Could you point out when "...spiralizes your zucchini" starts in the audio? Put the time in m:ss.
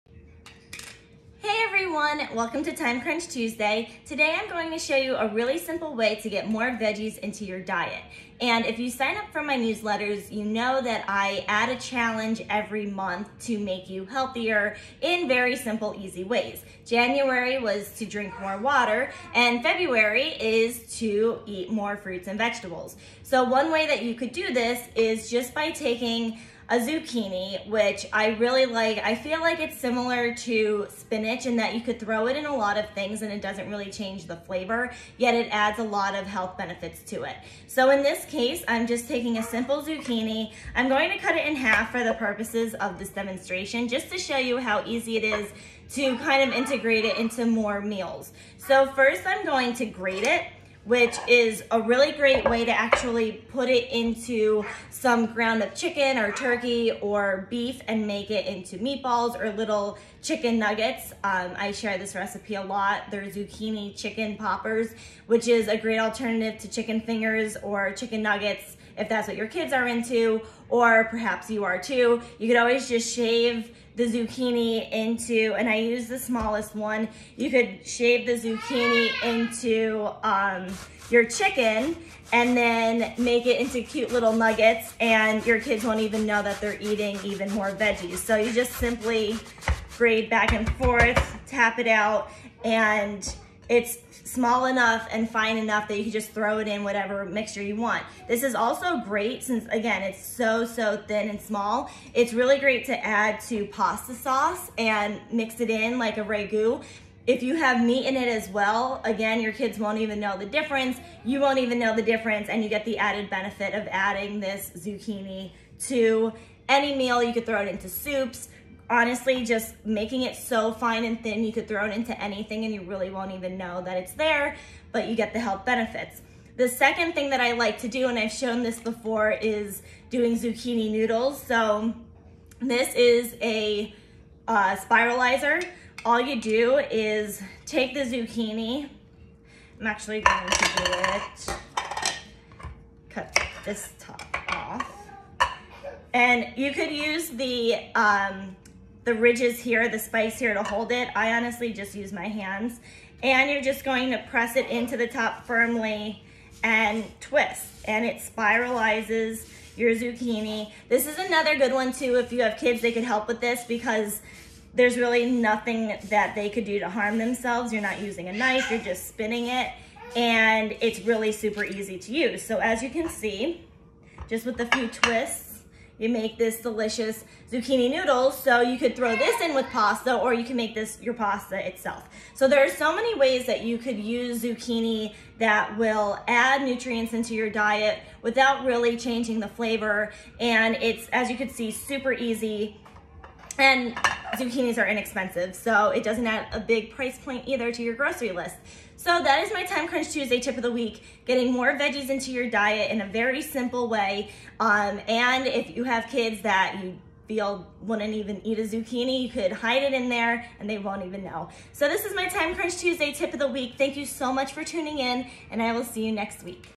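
2:38.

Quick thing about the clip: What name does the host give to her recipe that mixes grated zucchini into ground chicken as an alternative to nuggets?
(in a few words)
Zucchini chicken poppers.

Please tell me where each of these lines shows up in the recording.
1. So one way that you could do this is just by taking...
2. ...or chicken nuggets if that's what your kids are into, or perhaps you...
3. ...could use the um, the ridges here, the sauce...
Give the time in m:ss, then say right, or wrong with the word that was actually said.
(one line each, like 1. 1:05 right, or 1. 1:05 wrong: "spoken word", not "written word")
1. 0:23 right
2. 1:07 right
3. 2:26 wrong: "spice", not "sauce".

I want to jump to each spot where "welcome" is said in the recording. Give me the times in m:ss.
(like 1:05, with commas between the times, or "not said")
0:02.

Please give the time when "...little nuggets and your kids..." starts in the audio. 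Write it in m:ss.
1:24.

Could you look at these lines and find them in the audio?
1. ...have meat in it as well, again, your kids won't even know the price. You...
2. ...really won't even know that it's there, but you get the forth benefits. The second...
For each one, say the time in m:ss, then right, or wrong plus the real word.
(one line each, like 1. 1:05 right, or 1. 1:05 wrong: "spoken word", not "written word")
1. 1:47 wrong: "difference", not "price"
2. 2:02 wrong: "health", not "forth".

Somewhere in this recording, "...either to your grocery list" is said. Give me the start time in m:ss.
3:17.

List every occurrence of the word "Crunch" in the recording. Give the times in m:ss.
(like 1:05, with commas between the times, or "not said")
0:03, 3:19, 3:32.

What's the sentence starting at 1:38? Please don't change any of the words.
This is also great since, again, it's so, so thin and small.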